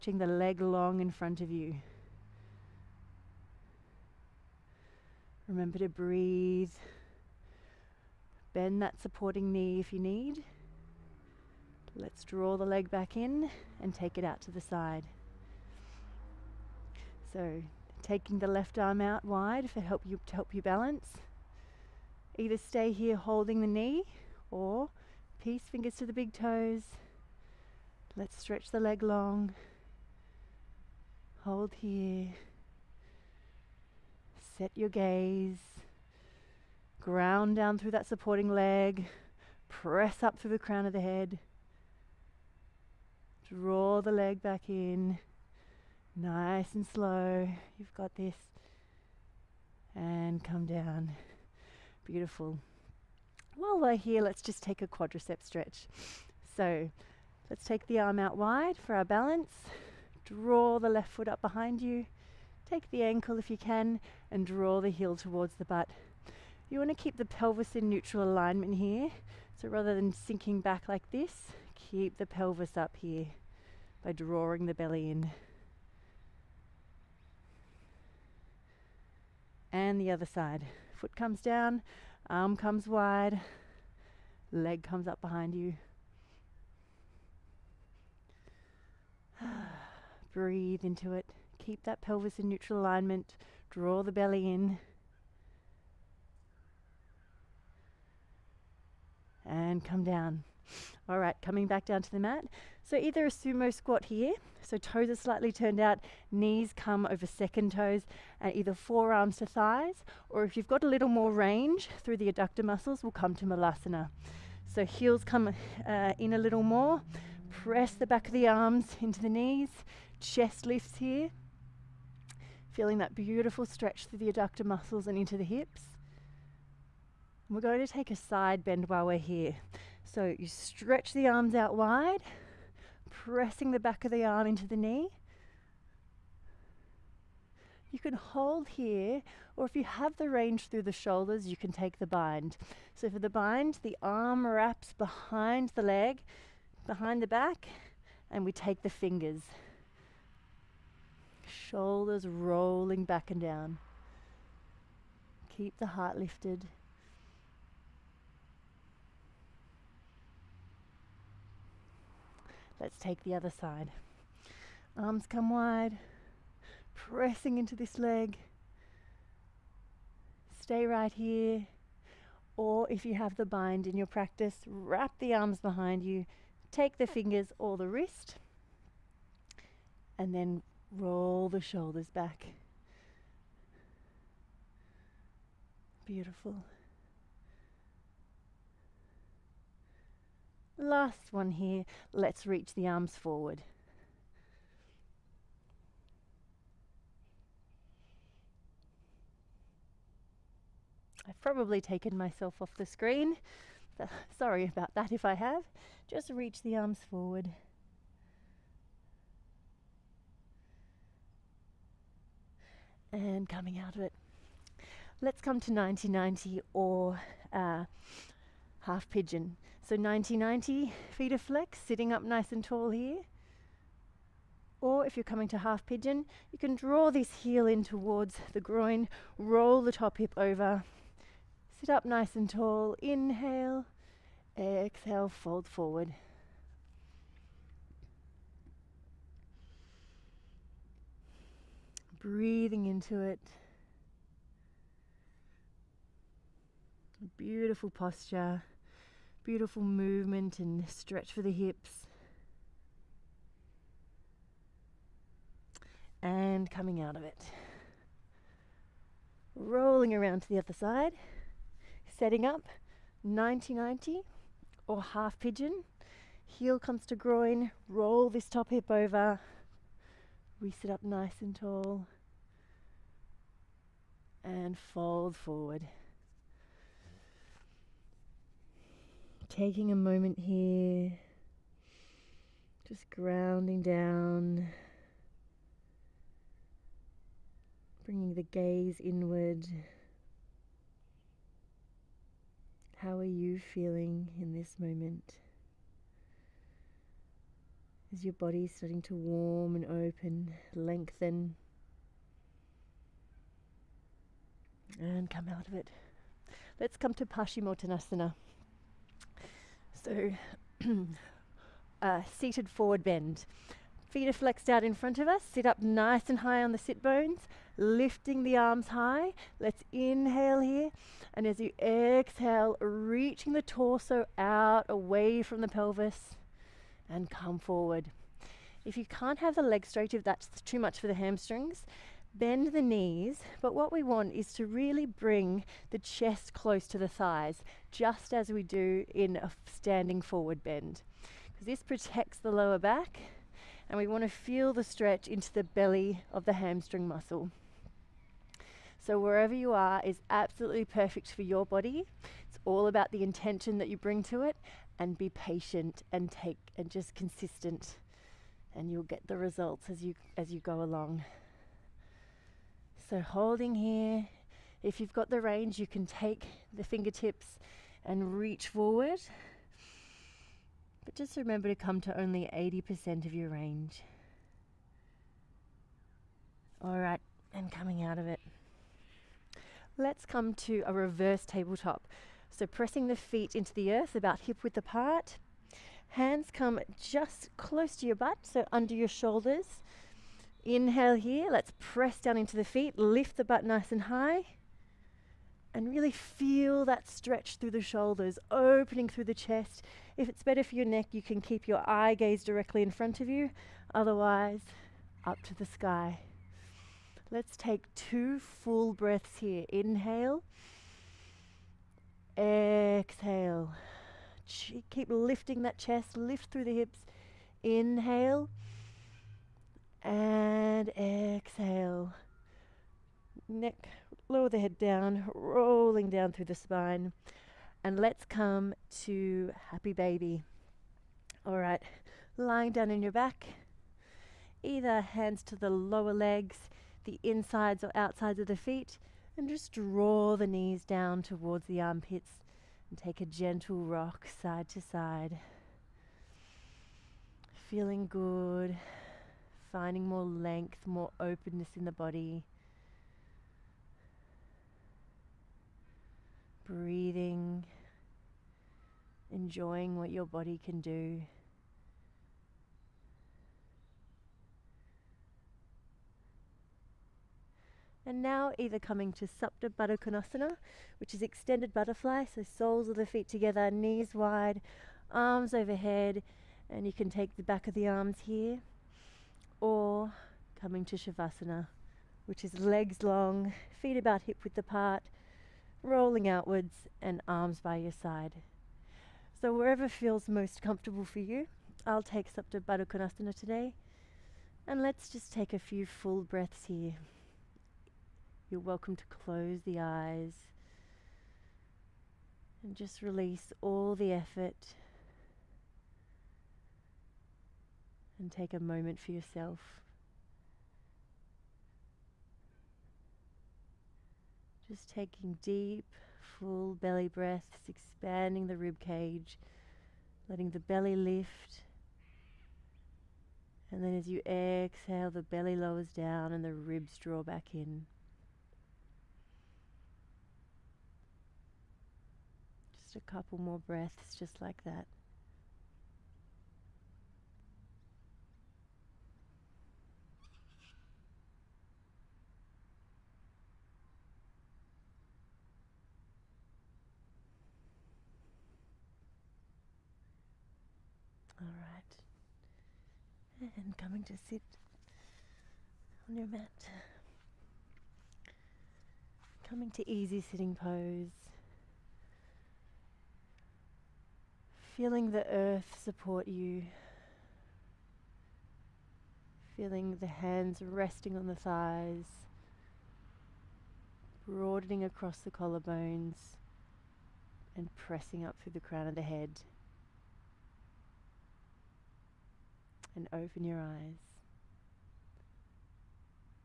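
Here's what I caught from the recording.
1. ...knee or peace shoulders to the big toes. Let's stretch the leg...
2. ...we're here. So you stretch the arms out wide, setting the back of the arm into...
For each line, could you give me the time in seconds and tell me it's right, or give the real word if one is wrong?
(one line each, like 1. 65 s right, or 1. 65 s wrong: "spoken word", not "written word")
1. 23 s wrong: "fingers", not "shoulders"
2. 129 s wrong: "pressing", not "setting".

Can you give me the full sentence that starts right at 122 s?
Feeling that beautiful stretch through the adductor muscles and into the hips.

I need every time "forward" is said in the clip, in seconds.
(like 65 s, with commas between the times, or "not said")
193 s, 207 s, 235 s, 275 s, 312 s, 327 s, 340 s, 368 s.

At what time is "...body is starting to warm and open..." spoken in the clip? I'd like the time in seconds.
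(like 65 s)
298 s.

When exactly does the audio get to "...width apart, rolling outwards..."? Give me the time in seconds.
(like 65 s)
484 s.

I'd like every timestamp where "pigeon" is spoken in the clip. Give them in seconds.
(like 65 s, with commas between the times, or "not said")
219 s, 225 s, 265 s.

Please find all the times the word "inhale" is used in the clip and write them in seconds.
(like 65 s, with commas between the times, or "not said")
233 s, 319 s, 390 s, 409 s, 417 s.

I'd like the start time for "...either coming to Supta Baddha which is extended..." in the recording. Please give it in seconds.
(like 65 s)
468 s.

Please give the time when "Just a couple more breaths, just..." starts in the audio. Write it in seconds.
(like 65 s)
532 s.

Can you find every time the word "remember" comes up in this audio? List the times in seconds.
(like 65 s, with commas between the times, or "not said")
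5 s, 371 s.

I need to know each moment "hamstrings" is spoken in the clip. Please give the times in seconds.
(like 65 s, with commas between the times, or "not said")
331 s, 346 s.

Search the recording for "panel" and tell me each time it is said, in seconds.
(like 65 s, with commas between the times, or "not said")
not said.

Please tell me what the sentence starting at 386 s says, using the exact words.
Hands come just close to your butt, so under your shoulders.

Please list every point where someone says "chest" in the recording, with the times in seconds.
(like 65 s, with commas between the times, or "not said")
120 s, 335 s, 399 s, 415 s.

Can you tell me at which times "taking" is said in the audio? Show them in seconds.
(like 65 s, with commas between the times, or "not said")
18 s, 279 s, 514 s.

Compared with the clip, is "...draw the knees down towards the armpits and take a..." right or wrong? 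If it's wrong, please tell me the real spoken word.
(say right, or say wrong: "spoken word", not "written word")
right.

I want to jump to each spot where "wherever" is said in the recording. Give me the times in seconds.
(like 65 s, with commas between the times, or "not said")
349 s, 489 s.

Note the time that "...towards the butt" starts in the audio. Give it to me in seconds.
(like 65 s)
65 s.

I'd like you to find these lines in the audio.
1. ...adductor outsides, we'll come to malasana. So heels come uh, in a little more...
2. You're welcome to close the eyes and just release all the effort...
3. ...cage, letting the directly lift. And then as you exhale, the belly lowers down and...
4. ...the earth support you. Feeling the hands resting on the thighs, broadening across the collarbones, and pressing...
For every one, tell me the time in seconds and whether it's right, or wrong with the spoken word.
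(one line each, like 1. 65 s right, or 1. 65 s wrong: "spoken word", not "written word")
1. 112 s wrong: "muscles", not "outsides"
2. 498 s right
3. 518 s wrong: "belly", not "directly"
4. 565 s right.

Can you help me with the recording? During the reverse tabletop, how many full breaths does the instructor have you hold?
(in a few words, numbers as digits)
2.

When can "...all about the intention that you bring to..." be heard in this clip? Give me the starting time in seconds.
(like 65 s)
352 s.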